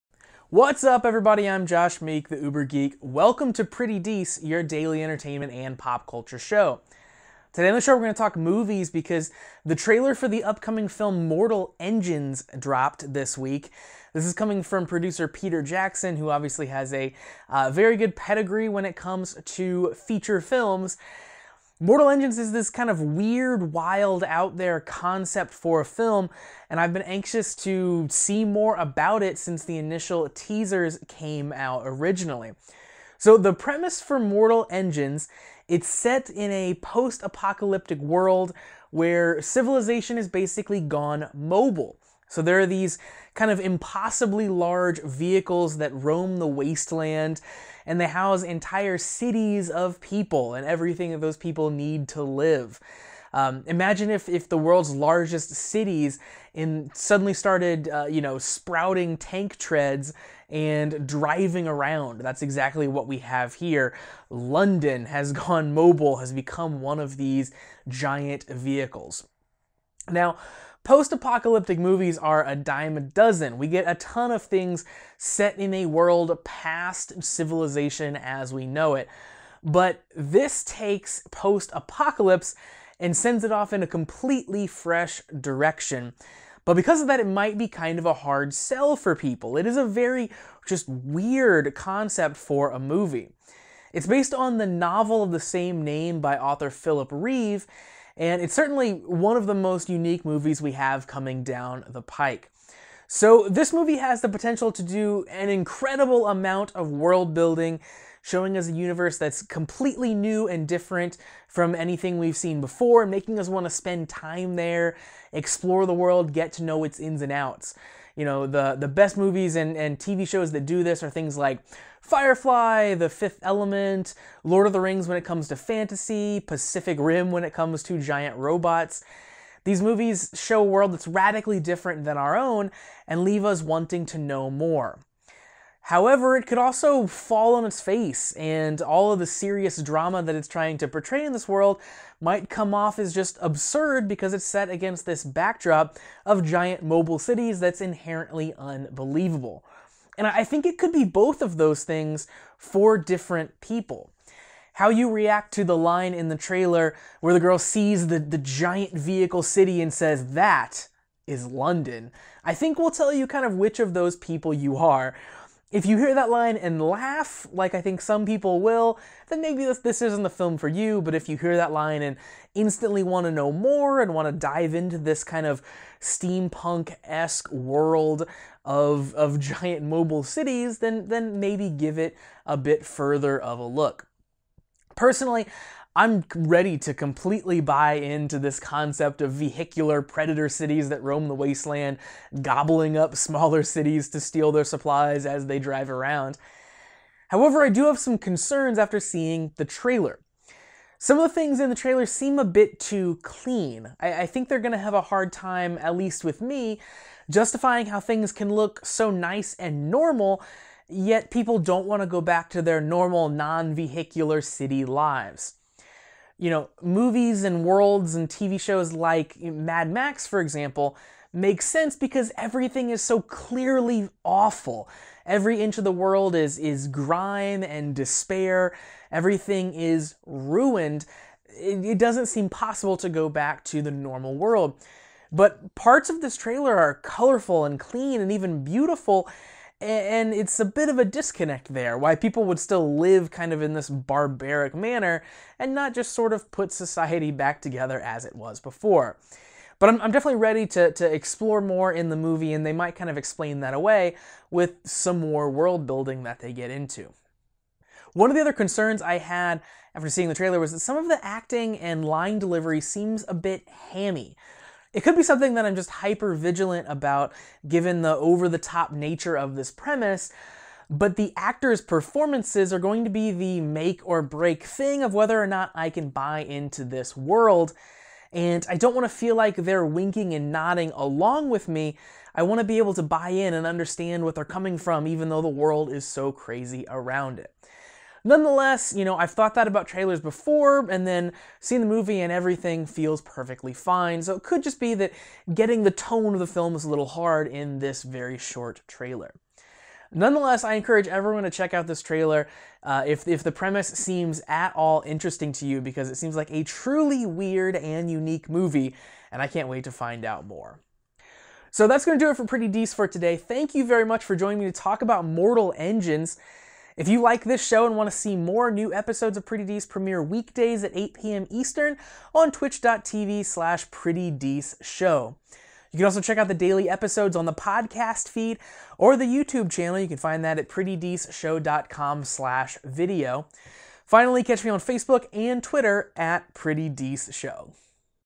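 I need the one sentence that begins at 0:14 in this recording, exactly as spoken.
This is coming from producer Peter Jackson, who obviously has a uh, very good pedigree when it comes to feature films.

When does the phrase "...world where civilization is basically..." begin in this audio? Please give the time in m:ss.
0:37.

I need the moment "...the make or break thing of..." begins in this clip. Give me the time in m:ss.
4:33.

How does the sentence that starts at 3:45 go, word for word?
Every inch of the world is is grime and despair.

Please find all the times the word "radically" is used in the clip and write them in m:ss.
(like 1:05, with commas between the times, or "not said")
2:11.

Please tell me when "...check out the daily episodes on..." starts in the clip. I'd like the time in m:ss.
5:26.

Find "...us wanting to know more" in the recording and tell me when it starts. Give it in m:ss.
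2:13.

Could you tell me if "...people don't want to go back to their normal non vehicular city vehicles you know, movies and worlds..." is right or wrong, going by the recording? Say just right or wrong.
wrong.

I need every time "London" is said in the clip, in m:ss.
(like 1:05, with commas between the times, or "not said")
1:04, 2:41.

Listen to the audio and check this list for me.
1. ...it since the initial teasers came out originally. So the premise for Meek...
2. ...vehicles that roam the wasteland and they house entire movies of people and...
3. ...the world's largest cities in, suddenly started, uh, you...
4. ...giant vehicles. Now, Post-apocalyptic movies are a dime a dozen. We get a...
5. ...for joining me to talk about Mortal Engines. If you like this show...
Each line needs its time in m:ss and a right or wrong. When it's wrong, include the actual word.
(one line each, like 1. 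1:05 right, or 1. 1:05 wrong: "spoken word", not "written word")
1. 0:29 wrong: "Mortal", not "Meek"
2. 0:45 wrong: "cities", not "movies"
3. 0:54 right
4. 1:07 right
5. 5:14 right.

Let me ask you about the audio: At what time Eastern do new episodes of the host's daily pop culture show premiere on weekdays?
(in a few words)
8 p.m.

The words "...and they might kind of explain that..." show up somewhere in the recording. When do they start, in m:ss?
4:12.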